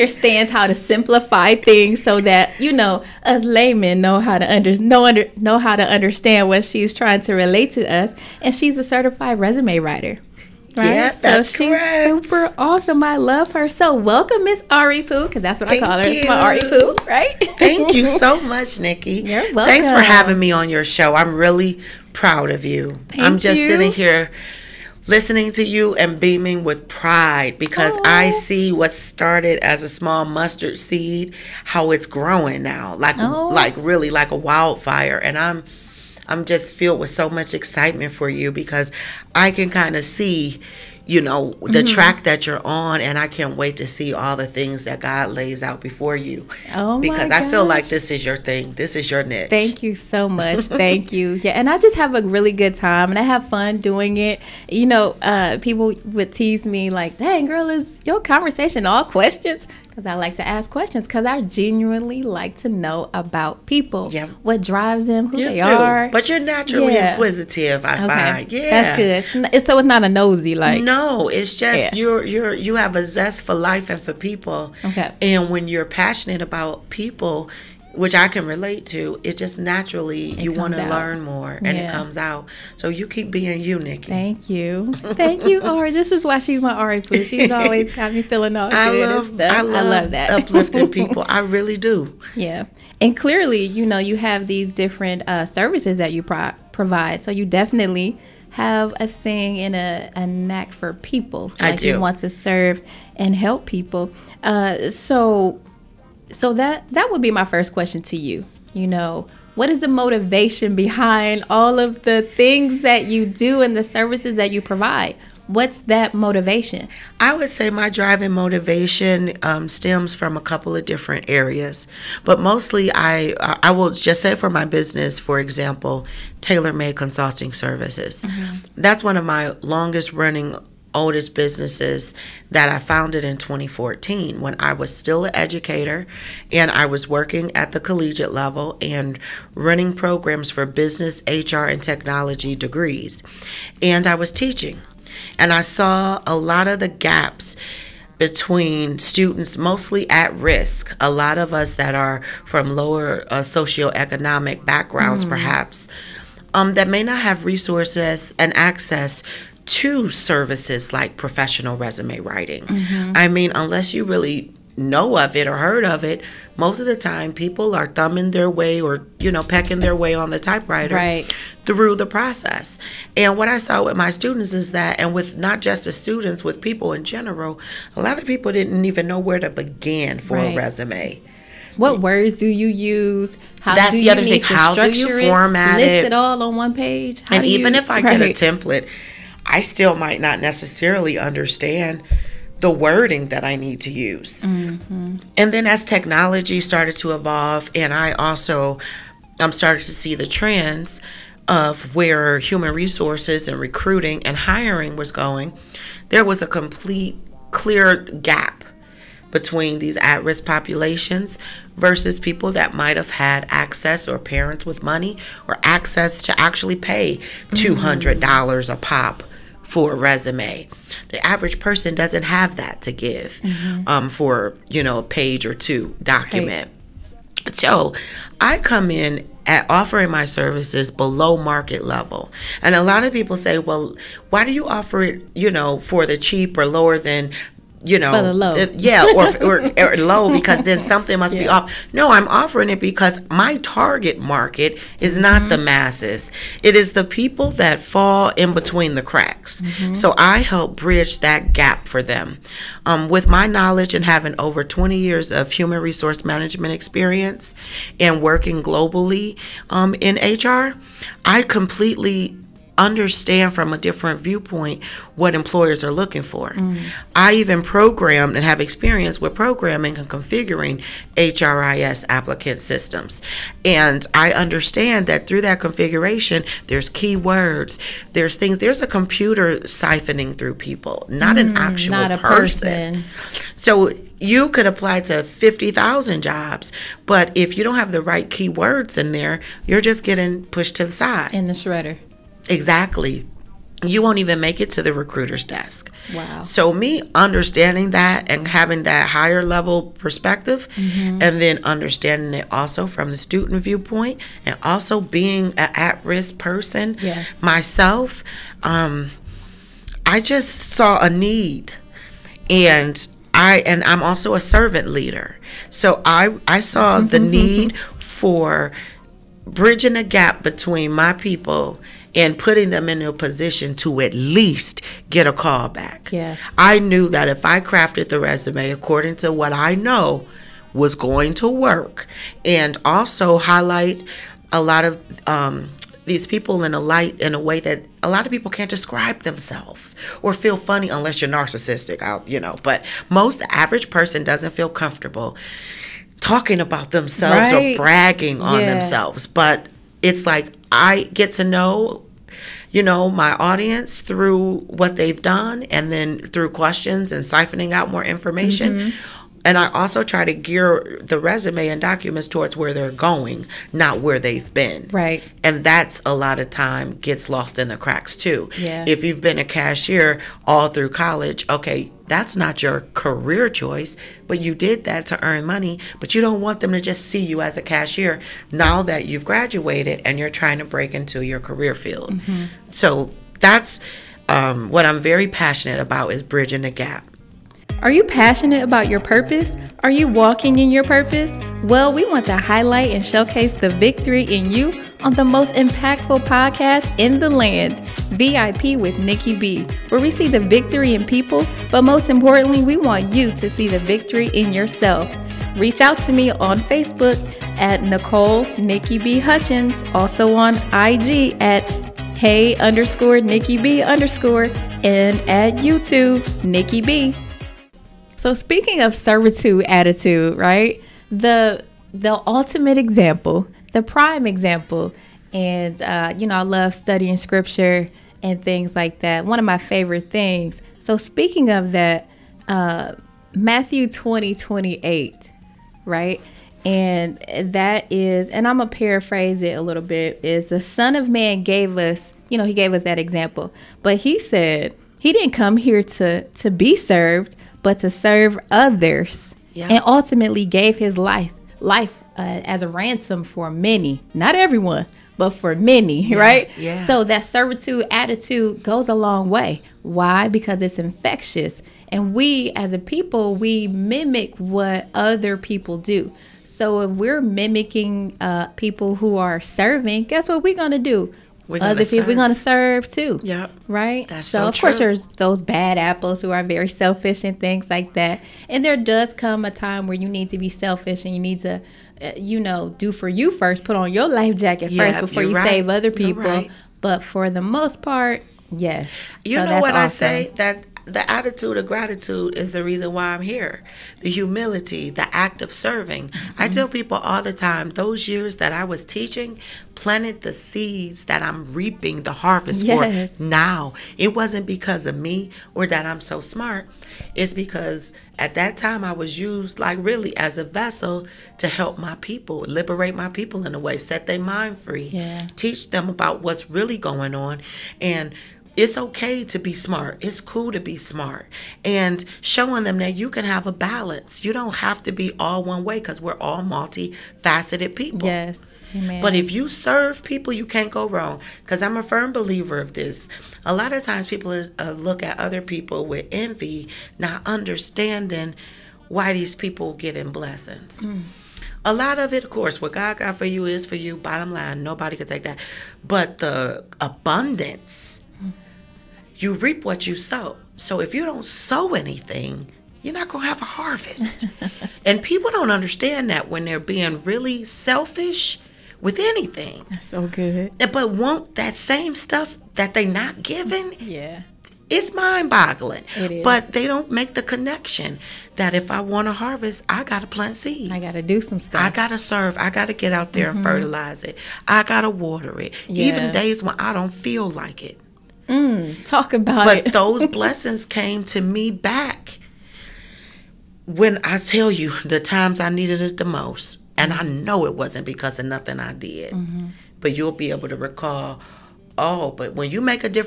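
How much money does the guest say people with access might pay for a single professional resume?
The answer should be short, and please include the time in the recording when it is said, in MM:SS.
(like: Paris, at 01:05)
$200, at 03:37.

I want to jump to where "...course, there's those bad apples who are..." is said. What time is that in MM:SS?
07:54.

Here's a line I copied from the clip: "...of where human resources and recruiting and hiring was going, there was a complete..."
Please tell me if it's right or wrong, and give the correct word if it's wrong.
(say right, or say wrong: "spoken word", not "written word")
right.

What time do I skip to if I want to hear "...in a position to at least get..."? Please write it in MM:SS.
05:22.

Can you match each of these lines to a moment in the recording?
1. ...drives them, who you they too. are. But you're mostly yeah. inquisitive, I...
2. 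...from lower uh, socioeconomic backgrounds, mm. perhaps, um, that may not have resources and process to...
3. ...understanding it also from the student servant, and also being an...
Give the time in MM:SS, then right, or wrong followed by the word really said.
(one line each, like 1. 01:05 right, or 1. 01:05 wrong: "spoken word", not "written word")
1. 01:04 wrong: "naturally", not "mostly"
2. 02:32 wrong: "access", not "process"
3. 05:01 wrong: "viewpoint", not "servant".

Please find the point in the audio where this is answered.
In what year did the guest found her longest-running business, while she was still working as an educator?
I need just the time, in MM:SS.
02:13.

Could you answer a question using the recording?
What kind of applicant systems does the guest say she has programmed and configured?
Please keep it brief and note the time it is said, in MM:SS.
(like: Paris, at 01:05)
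HRIS, at 04:31.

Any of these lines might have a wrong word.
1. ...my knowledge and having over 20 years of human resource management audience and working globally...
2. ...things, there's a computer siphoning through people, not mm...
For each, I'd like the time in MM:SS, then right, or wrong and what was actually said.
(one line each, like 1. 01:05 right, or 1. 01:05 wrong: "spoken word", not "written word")
1. 04:13 wrong: "experience", not "audience"
2. 04:38 right.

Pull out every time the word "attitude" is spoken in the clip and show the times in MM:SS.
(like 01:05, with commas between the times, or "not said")
06:59, 07:37, 08:11.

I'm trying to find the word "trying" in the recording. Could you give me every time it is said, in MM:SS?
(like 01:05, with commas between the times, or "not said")
00:06, 06:20.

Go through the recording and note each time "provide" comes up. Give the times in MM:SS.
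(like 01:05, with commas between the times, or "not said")
01:36, 01:54.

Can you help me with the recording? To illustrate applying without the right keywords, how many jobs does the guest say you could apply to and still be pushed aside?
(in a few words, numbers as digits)
50,000.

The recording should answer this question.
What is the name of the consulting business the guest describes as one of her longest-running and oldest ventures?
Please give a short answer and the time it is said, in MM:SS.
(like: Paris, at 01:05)
Taylor Made Consulting Services, at 02:06.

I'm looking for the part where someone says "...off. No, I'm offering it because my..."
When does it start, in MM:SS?
04:01.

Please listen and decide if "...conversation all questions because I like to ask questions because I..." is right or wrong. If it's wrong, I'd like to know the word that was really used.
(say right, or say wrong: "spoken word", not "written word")
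right.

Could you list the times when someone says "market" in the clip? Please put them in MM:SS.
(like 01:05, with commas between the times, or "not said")
03:51, 04:04.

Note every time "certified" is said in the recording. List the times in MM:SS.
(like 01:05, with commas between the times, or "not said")
00:08.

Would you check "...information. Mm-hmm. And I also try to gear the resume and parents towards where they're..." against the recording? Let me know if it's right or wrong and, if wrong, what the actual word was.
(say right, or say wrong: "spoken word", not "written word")
wrong: "documents", not "parents".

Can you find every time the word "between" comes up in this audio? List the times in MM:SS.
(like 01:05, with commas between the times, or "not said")
02:28, 03:29, 04:08, 05:20.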